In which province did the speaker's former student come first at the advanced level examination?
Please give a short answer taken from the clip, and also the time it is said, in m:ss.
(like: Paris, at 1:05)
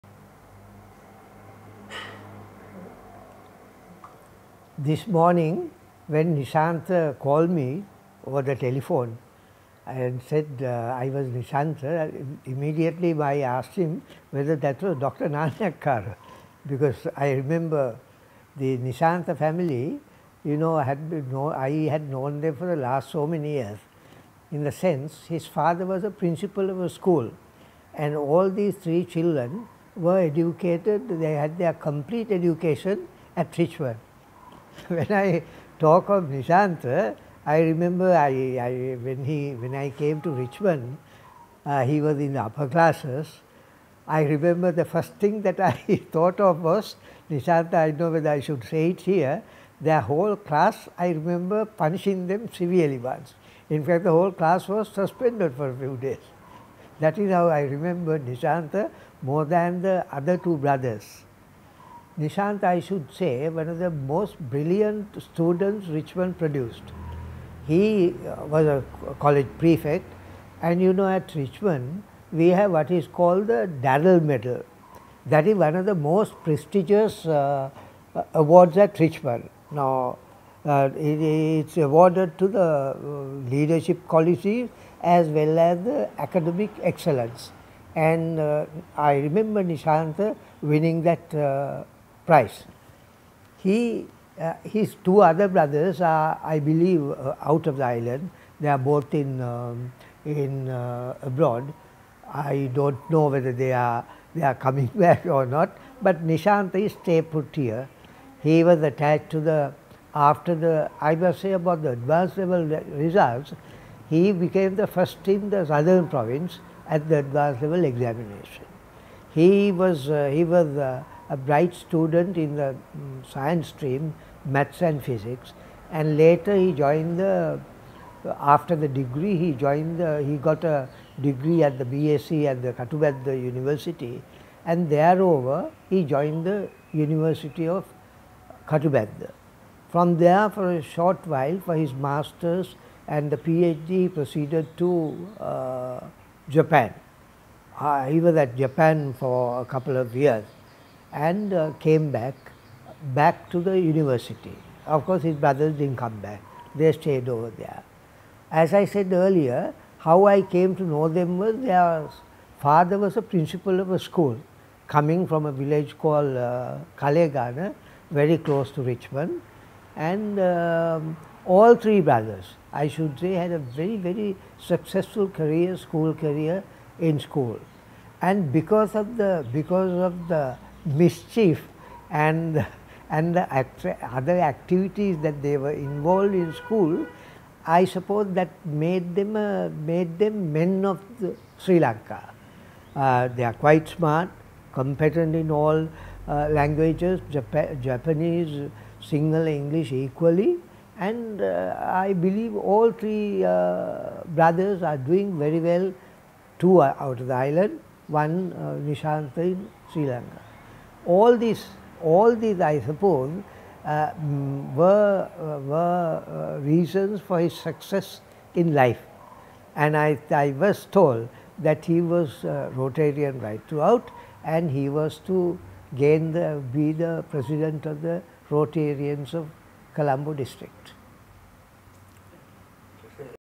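Southern Province, at 1:55.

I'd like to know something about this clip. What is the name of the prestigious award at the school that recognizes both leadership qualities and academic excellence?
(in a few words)
Darrell Medal.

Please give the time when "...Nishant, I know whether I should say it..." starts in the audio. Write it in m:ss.
0:47.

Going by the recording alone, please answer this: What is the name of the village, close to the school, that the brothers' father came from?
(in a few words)
Kalegana.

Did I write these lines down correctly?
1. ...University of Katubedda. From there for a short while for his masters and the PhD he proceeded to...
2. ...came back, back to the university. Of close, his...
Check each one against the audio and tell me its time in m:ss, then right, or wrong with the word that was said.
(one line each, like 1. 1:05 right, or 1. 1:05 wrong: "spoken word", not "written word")
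1. 2:16 right
2. 2:31 wrong: "course", not "close".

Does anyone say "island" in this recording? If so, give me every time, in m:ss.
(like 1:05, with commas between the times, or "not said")
1:37, 3:27.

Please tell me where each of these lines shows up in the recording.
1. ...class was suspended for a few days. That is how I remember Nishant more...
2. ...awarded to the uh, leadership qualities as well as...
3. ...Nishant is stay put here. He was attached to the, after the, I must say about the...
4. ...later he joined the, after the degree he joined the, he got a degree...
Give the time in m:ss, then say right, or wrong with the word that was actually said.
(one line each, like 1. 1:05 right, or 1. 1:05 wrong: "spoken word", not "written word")
1. 0:54 right
2. 1:21 right
3. 1:46 right
4. 2:06 right.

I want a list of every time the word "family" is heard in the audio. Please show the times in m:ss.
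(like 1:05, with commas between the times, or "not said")
0:19.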